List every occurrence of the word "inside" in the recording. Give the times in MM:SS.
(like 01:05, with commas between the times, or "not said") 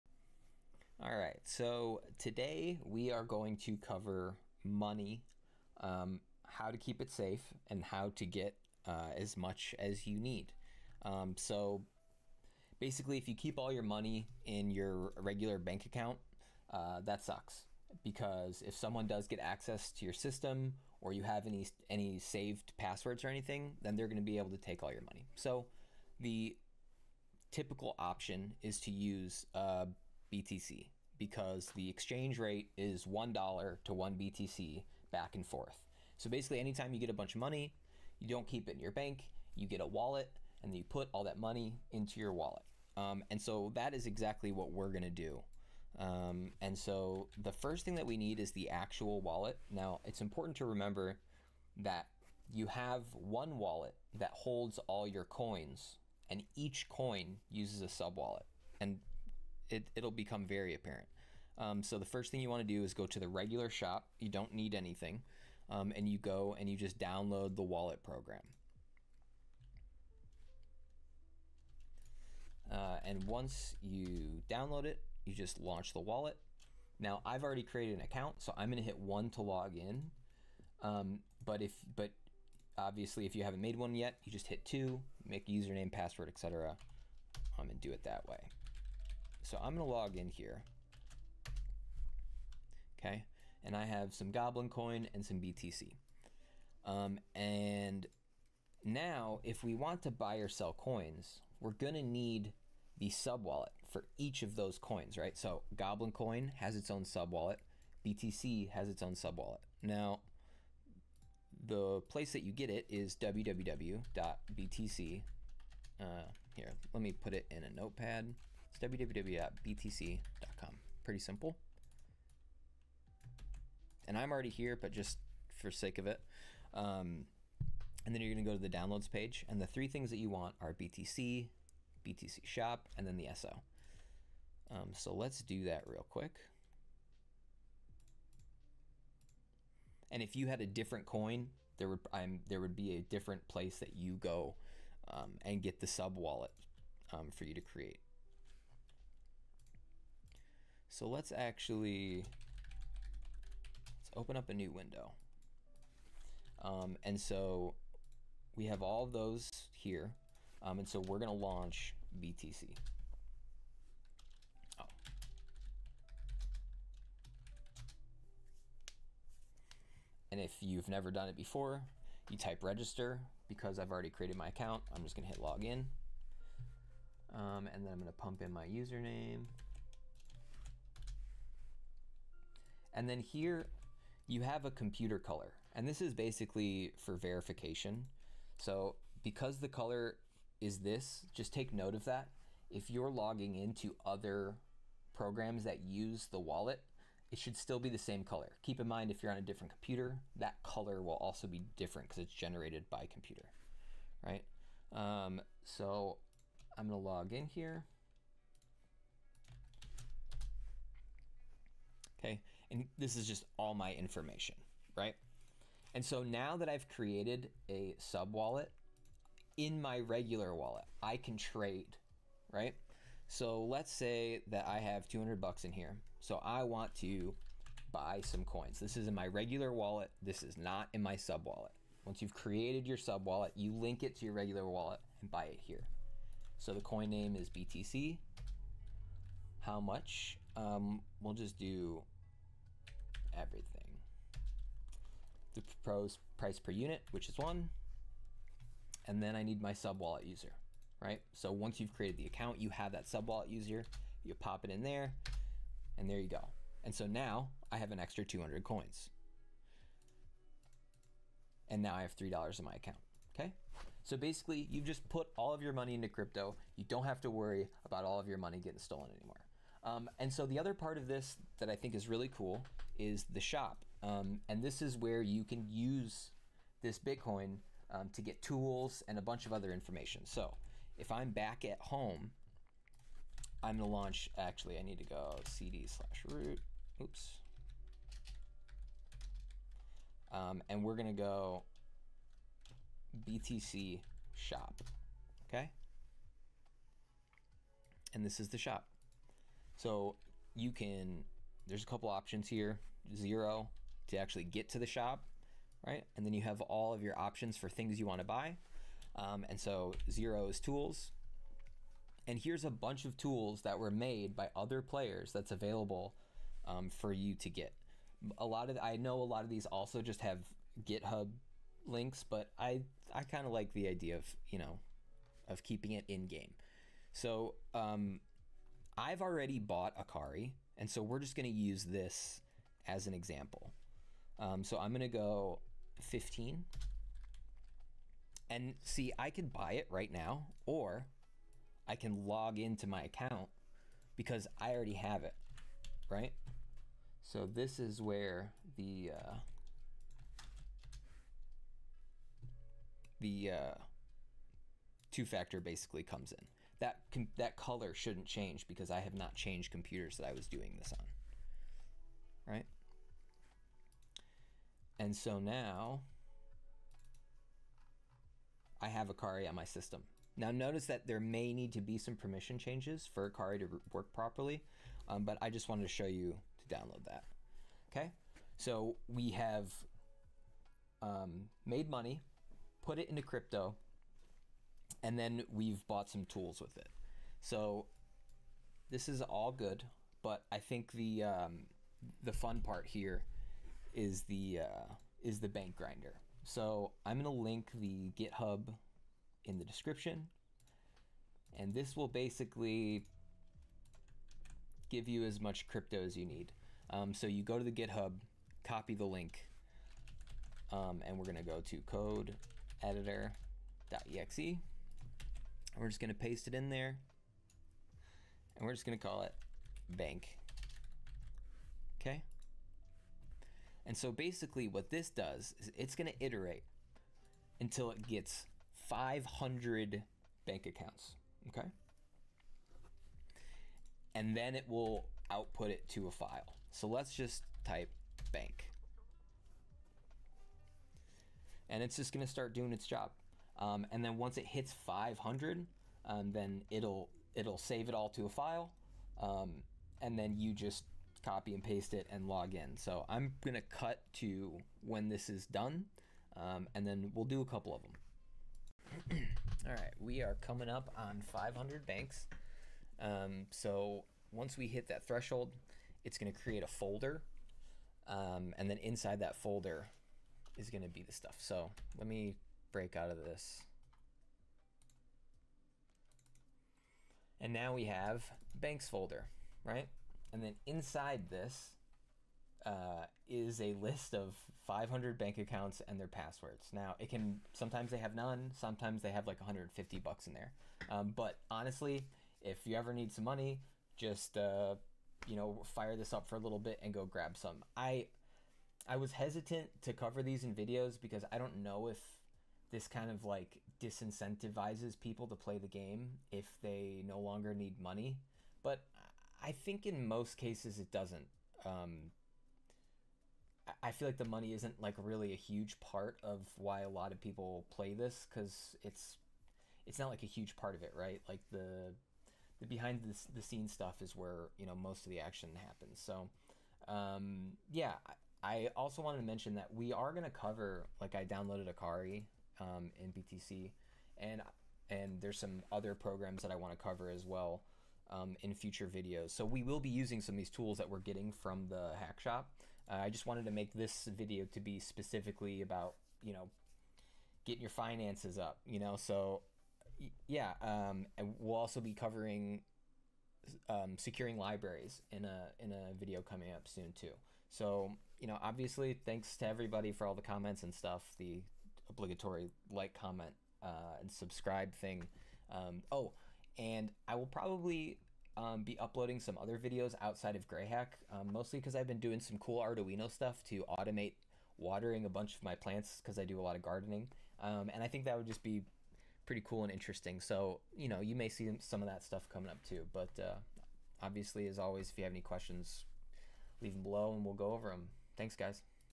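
07:48, 08:00.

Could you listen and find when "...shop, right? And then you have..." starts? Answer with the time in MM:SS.
05:04.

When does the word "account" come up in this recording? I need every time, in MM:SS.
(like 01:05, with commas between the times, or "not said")
00:15, 01:18, 02:54, 04:12, 04:22, 05:43, 07:10, 08:05.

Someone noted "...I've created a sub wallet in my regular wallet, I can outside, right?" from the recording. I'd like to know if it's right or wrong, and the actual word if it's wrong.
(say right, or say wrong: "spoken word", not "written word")
wrong: "trade", not "outside".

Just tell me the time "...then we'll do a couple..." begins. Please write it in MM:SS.
07:36.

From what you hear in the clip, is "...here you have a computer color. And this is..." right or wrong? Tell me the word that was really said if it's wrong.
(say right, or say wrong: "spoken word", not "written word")
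right.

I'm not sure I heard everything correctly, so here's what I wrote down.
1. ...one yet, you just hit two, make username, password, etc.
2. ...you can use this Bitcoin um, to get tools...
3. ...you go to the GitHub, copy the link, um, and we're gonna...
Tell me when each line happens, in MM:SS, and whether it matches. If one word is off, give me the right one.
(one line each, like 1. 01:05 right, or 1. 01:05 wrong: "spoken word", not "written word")
1. 01:23 right
2. 04:35 right
3. 06:47 right.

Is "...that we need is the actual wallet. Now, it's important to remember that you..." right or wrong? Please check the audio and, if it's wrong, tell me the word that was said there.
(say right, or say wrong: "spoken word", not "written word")
right.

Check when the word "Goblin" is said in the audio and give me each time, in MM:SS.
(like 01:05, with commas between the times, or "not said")
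01:34, 01:45.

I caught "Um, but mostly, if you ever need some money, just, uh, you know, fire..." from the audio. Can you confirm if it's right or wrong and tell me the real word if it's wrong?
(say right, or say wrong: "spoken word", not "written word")
wrong: "honestly", not "mostly".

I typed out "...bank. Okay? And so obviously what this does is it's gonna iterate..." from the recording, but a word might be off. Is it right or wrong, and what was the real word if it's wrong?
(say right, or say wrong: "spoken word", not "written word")
wrong: "basically", not "obviously".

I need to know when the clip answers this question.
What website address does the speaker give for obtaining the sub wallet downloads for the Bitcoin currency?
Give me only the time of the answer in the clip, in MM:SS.
01:58.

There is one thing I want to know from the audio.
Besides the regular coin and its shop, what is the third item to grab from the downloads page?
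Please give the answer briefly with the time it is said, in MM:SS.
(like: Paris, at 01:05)
the SO, at 02:13.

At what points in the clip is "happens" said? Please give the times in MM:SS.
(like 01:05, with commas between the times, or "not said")
08:45.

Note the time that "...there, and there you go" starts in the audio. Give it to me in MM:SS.
04:14.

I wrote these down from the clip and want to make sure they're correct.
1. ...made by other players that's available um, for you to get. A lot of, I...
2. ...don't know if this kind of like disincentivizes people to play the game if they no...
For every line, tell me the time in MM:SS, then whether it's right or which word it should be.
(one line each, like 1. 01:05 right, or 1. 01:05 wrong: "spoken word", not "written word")
1. 05:13 right
2. 08:21 right.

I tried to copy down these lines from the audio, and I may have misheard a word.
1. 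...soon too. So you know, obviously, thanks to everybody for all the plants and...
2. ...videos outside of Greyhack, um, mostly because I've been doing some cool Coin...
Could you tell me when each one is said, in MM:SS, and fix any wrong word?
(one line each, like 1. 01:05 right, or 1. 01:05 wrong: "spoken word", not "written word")
1. 09:16 wrong: "comments", not "plants"
2. 09:29 wrong: "Arduino", not "Coin".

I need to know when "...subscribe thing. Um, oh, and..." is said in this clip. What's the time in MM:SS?
09:24.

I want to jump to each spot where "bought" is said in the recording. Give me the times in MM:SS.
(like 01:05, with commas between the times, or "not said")
05:29, 06:25.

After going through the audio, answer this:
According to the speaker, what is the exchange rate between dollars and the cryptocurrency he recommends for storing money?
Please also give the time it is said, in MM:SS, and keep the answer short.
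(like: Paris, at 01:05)
$1 to 1 BTC, at 00:33.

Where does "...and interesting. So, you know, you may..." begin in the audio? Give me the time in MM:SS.
09:39.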